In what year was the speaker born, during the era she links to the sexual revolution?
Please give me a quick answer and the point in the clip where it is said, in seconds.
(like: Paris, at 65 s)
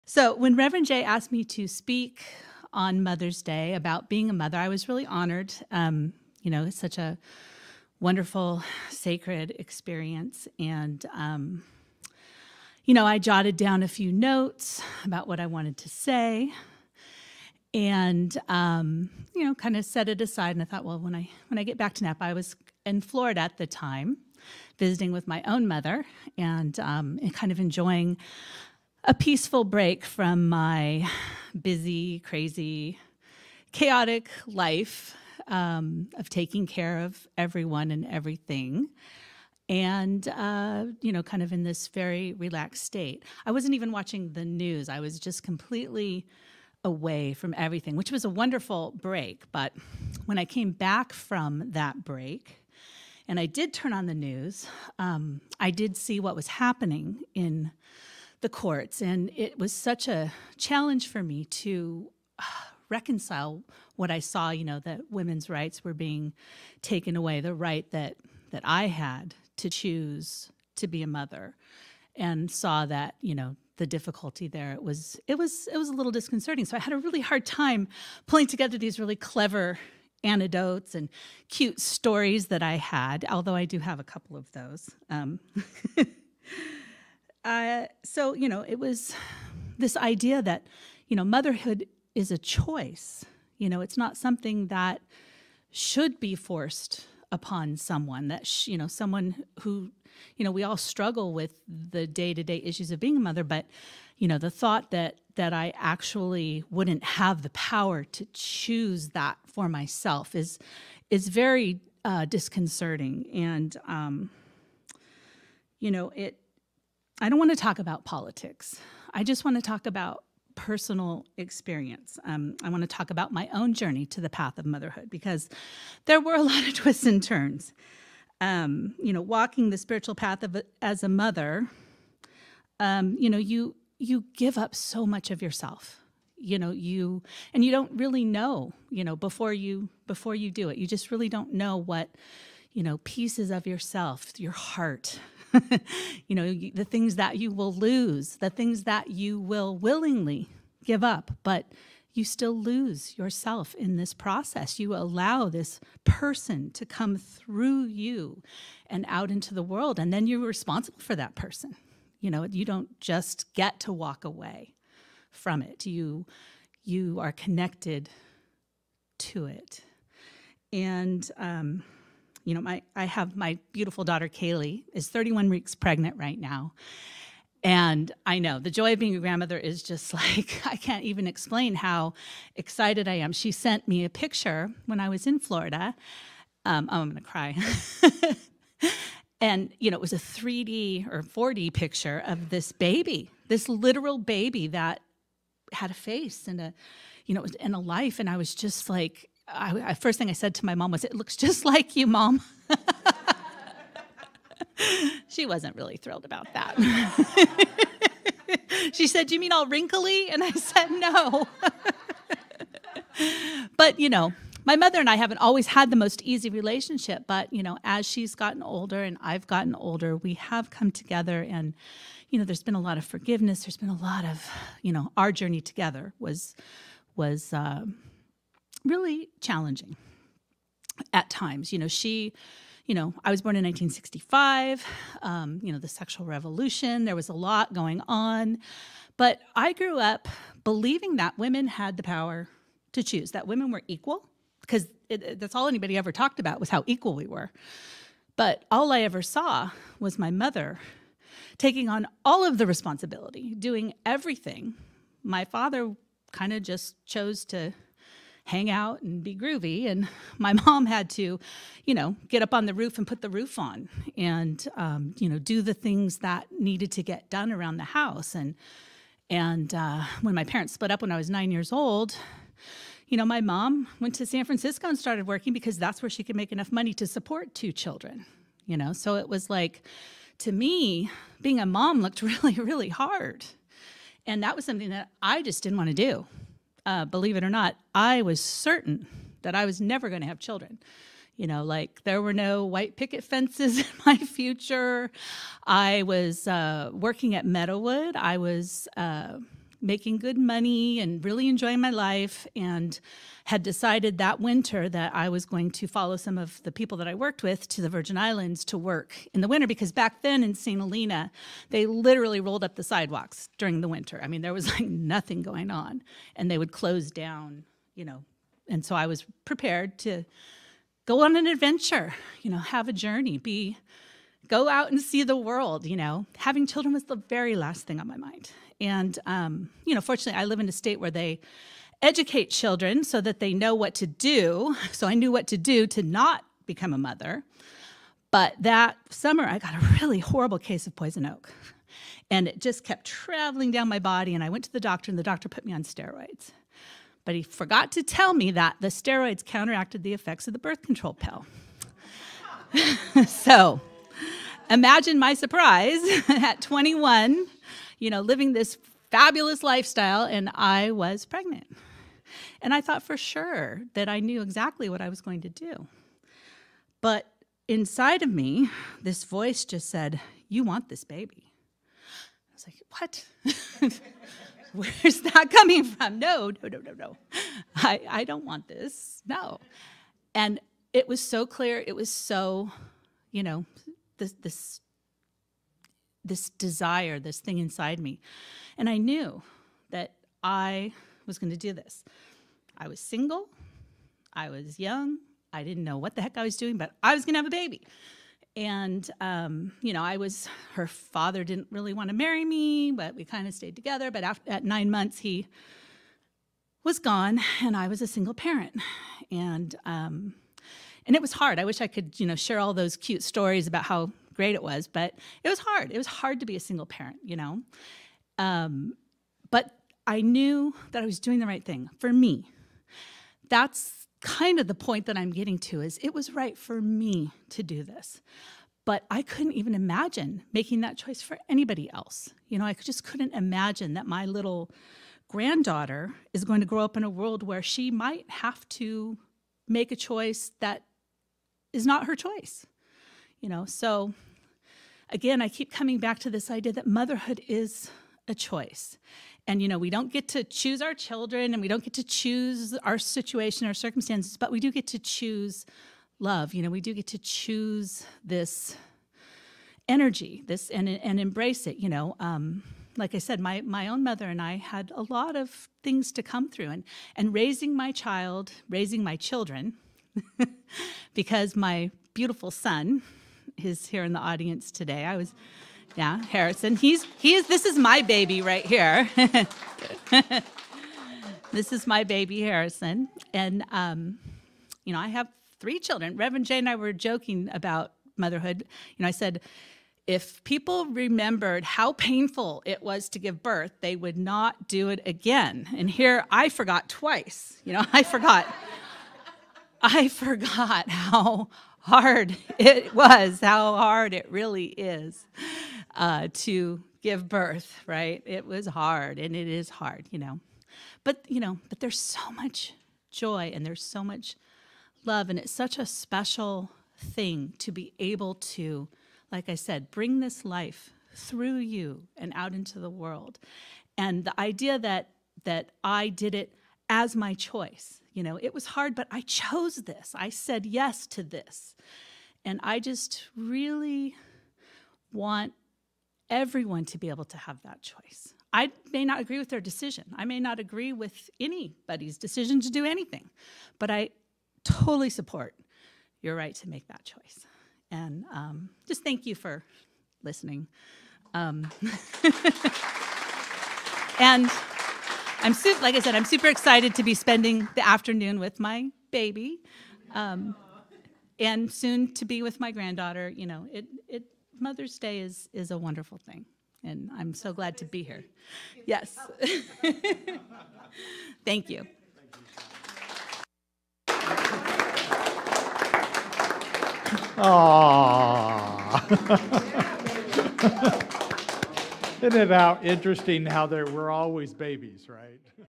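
1965, at 233 s.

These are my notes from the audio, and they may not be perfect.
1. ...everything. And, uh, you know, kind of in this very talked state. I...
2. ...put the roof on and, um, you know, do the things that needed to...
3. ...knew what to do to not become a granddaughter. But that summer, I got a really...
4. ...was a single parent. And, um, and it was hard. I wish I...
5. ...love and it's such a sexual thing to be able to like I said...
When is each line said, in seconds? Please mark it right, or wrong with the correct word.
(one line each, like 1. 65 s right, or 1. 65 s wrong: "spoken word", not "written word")
1. 38 s wrong: "relaxed", not "talked"
2. 263 s right
3. 335 s wrong: "mother", not "granddaughter"
4. 407 s right
5. 515 s wrong: "special", not "sexual".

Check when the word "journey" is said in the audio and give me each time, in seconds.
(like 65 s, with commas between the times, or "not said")
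123 s, 225 s, 322 s.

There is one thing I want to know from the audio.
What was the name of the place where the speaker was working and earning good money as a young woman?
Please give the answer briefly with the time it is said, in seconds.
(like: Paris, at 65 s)
Meadowood, at 297 s.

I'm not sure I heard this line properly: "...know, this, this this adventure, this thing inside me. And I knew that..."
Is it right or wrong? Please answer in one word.
wrong.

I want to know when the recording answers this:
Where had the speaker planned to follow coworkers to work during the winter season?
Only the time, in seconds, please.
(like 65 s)
307 s.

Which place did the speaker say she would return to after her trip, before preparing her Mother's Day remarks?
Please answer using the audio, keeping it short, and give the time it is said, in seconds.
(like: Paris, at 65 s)
Napa, at 22 s.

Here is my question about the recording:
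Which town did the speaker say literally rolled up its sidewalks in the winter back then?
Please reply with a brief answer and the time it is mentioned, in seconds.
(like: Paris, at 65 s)
St. Helena, at 310 s.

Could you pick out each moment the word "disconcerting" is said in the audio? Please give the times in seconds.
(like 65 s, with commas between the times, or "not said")
76 s, 112 s.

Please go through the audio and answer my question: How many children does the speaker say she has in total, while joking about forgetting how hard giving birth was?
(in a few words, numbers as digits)
3.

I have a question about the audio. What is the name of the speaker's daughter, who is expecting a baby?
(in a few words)
Kaylee.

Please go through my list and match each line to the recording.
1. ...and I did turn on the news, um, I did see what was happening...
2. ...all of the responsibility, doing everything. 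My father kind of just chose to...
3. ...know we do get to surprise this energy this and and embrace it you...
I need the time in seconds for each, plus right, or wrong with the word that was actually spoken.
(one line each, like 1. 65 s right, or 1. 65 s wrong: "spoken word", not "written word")
1. 53 s right
2. 252 s right
3. 456 s wrong: "choose", not "surprise".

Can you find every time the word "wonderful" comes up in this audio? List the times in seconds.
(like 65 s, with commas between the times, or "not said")
8 s, 48 s, 565 s.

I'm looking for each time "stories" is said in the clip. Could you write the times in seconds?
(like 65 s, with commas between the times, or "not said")
81 s, 413 s.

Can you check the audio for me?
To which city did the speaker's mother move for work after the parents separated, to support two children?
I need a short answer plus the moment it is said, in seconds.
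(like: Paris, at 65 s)
San Francisco, at 274 s.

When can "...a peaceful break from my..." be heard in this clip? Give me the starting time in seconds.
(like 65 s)
29 s.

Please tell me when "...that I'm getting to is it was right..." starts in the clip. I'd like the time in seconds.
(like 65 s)
425 s.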